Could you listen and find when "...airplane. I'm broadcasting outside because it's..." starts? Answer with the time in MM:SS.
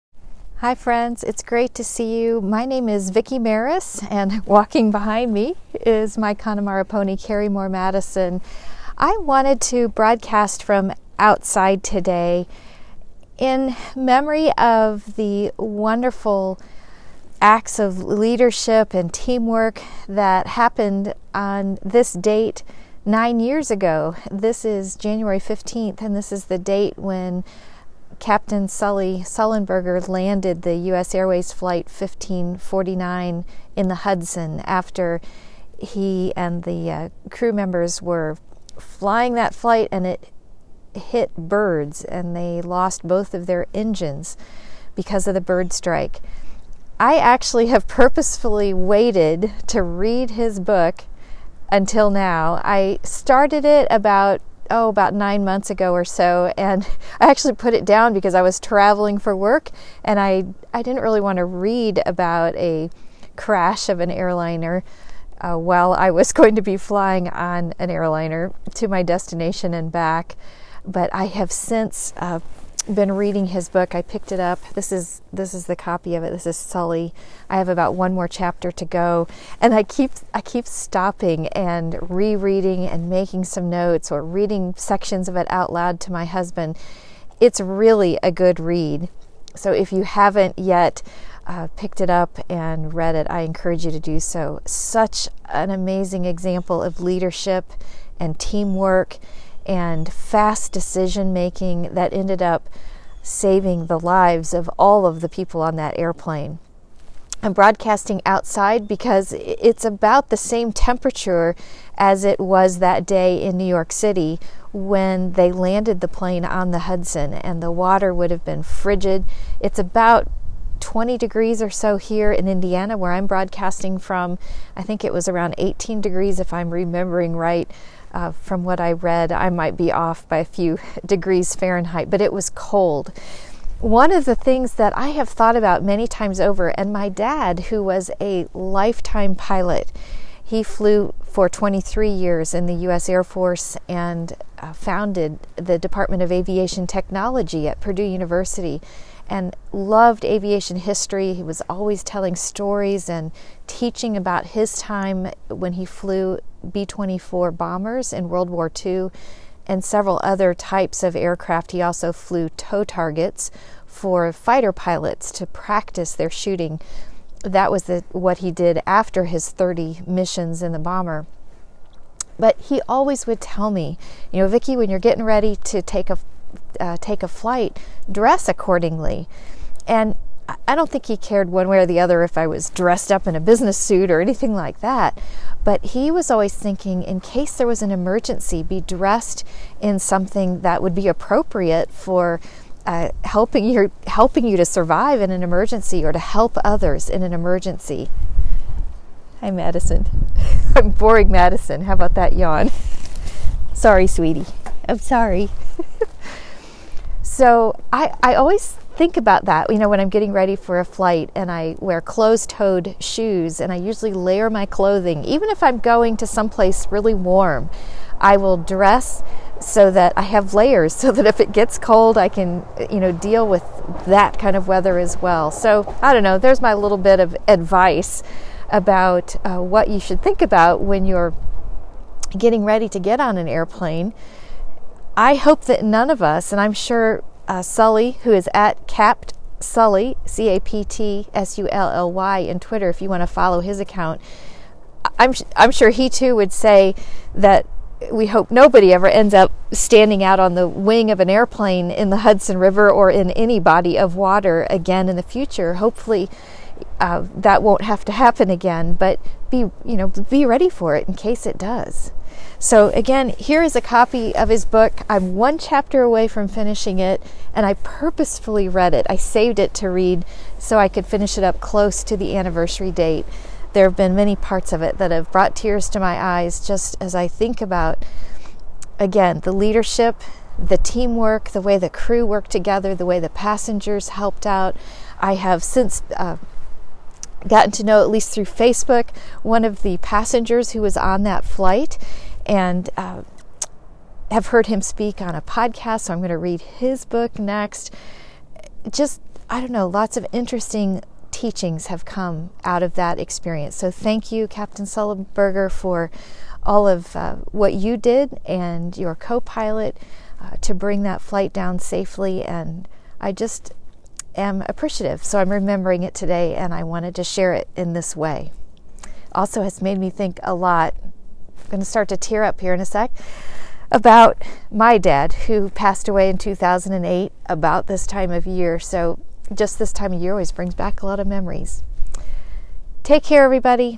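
01:45.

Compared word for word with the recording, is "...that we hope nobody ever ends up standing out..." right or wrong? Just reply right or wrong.
right.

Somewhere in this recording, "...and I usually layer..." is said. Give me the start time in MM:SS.
03:33.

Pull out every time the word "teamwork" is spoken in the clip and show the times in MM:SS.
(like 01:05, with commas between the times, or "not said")
00:19, 01:38, 04:40.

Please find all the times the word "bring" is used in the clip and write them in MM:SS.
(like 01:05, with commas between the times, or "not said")
05:10, 05:30.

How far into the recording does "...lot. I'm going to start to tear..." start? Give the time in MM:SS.
05:20.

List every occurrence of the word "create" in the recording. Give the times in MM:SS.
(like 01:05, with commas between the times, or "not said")
not said.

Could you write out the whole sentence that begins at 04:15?
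Hopefully, uh, that won't have to happen again, but be, you know, be ready for it in case it does.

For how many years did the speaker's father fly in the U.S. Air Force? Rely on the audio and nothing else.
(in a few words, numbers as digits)
23.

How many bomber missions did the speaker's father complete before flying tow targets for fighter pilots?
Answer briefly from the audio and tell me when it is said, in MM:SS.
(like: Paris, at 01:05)
30, at 02:49.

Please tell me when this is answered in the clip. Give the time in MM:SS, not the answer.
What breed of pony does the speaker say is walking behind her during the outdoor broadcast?
00:06.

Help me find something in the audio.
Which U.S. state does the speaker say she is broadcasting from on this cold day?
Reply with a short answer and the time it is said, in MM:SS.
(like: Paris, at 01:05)
Indiana, at 02:02.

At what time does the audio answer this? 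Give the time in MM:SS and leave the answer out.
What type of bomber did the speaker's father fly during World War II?
02:36.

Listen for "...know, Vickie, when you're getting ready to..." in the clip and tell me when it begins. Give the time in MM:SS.
02:54.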